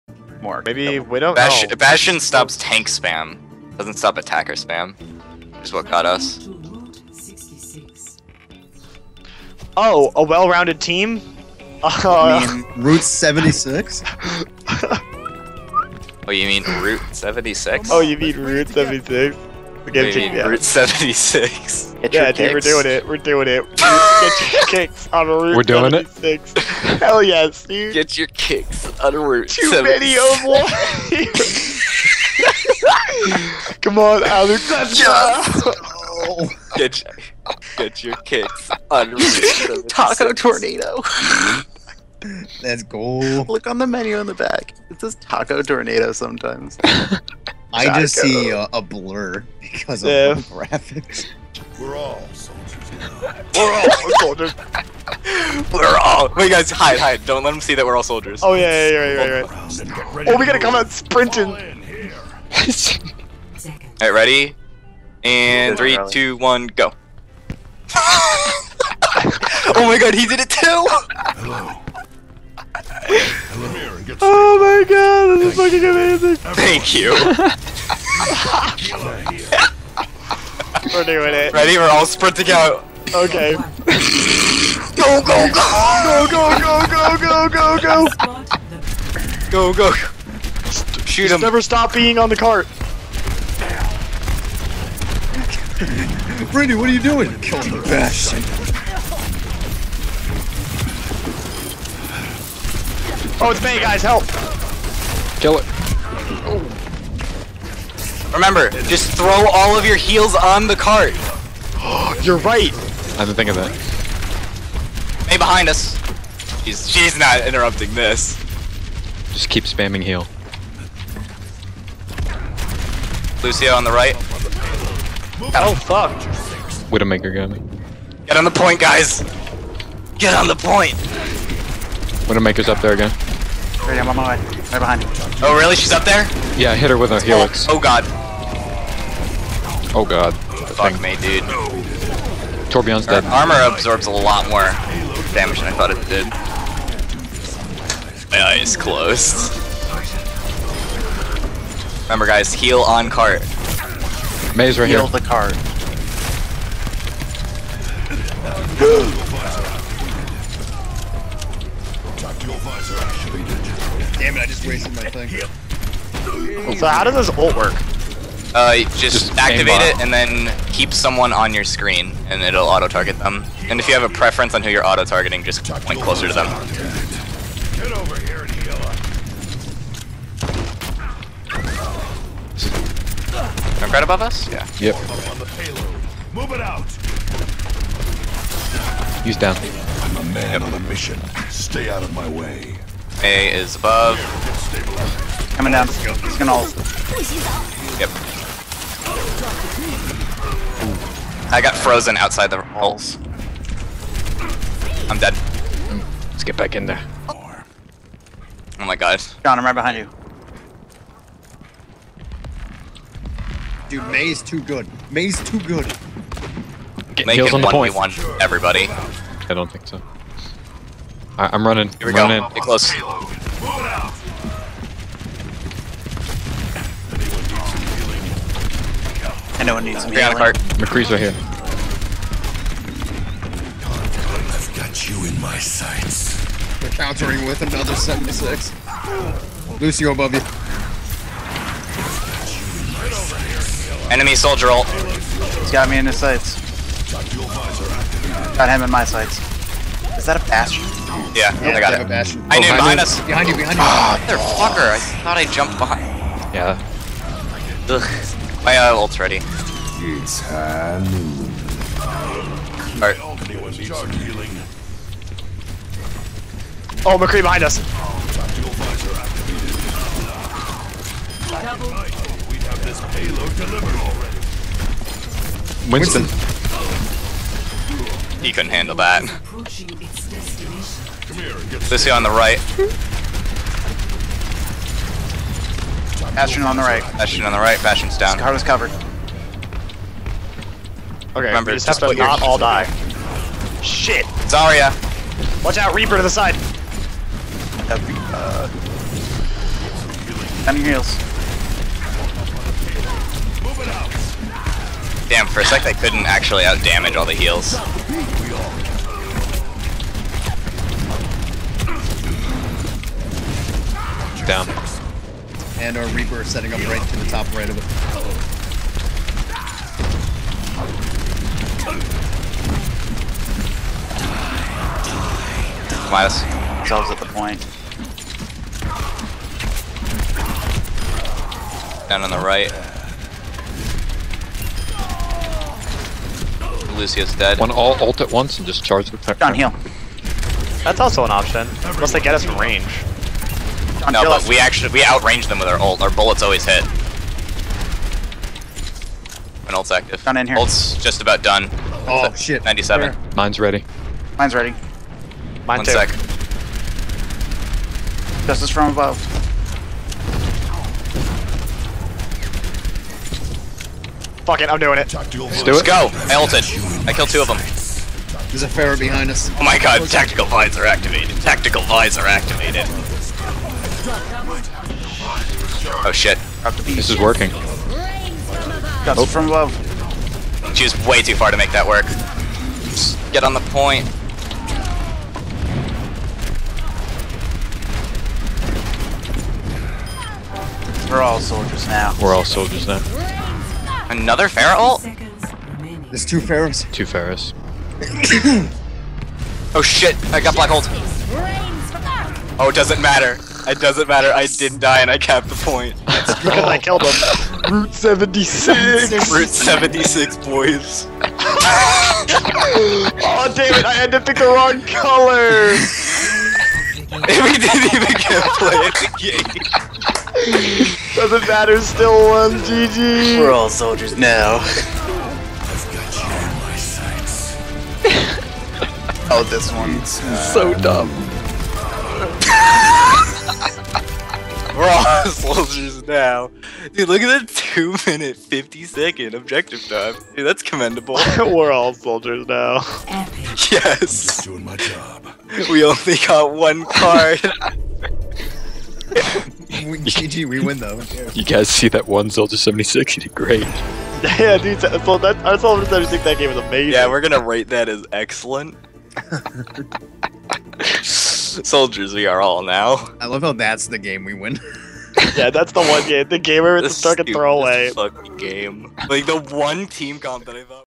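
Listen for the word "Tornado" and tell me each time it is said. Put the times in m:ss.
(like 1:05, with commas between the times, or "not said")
0:40, 0:45.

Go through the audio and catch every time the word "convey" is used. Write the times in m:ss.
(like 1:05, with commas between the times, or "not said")
not said.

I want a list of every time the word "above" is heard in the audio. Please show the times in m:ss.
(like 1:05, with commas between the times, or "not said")
3:04, 3:13, 4:00, 5:58, 6:19.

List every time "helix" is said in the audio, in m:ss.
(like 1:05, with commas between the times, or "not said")
2:17.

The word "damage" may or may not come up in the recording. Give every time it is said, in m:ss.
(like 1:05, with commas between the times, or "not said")
2:25, 5:06.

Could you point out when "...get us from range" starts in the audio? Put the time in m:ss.
5:42.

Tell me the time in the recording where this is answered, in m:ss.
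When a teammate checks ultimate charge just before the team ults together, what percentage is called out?
5:52.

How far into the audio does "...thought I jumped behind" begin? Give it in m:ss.
4:15.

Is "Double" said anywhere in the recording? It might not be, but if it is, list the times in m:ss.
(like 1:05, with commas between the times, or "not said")
4:33.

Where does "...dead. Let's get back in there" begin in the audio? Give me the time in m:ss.
3:25.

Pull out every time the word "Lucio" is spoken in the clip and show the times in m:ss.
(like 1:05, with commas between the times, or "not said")
2:03, 3:59, 5:37.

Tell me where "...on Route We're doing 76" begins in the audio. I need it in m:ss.
0:25.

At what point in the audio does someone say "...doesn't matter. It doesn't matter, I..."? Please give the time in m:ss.
6:42.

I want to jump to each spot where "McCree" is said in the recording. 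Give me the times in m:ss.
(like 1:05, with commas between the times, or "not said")
3:50, 4:27.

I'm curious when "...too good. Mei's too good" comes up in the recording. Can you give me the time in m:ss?
3:34.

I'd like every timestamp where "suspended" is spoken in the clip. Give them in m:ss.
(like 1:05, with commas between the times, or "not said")
not said.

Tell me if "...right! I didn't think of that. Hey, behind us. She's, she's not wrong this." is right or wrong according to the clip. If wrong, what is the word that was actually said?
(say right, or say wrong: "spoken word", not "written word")
wrong: "interrupting", not "wrong".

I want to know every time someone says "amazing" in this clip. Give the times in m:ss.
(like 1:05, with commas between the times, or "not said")
1:15, 7:36.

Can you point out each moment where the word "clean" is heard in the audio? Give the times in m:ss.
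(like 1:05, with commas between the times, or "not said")
not said.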